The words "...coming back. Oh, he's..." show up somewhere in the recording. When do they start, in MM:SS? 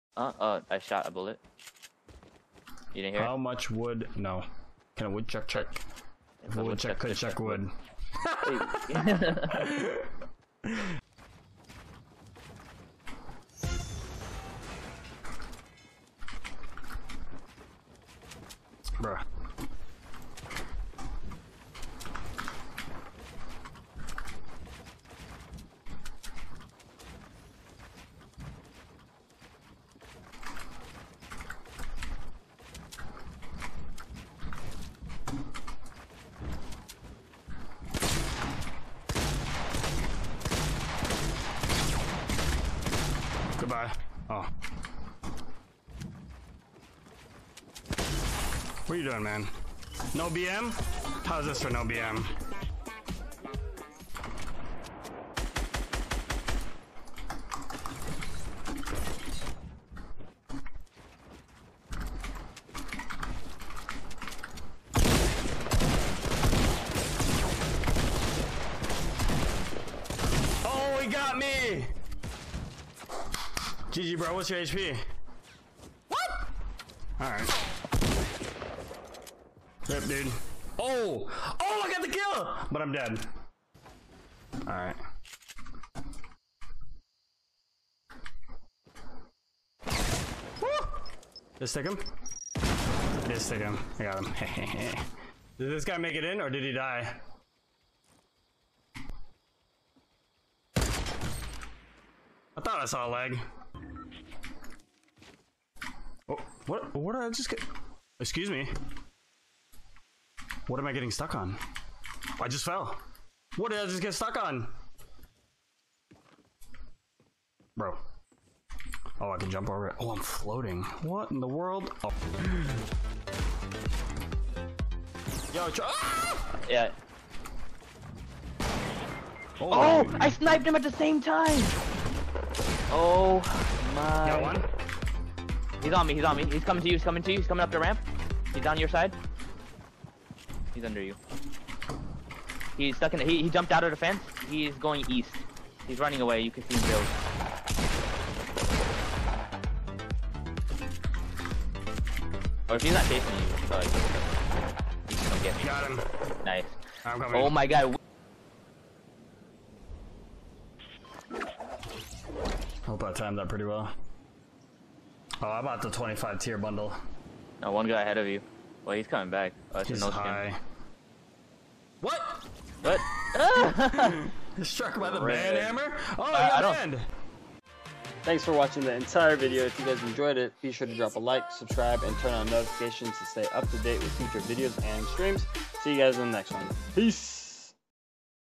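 02:49.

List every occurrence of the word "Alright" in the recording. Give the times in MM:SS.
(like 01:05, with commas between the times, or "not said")
01:17, 01:24.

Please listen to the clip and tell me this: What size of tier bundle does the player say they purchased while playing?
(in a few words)
25.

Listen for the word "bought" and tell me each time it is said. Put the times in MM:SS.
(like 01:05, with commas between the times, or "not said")
02:45.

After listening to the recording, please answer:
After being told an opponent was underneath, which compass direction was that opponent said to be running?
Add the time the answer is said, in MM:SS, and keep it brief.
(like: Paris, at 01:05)
east, at 02:25.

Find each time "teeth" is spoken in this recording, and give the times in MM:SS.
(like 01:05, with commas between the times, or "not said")
not said.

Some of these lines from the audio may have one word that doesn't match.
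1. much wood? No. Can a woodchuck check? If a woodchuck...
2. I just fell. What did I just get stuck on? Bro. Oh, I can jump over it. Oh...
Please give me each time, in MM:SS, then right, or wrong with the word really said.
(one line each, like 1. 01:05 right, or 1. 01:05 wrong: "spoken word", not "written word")
1. 00:03 right
2. 01:52 right.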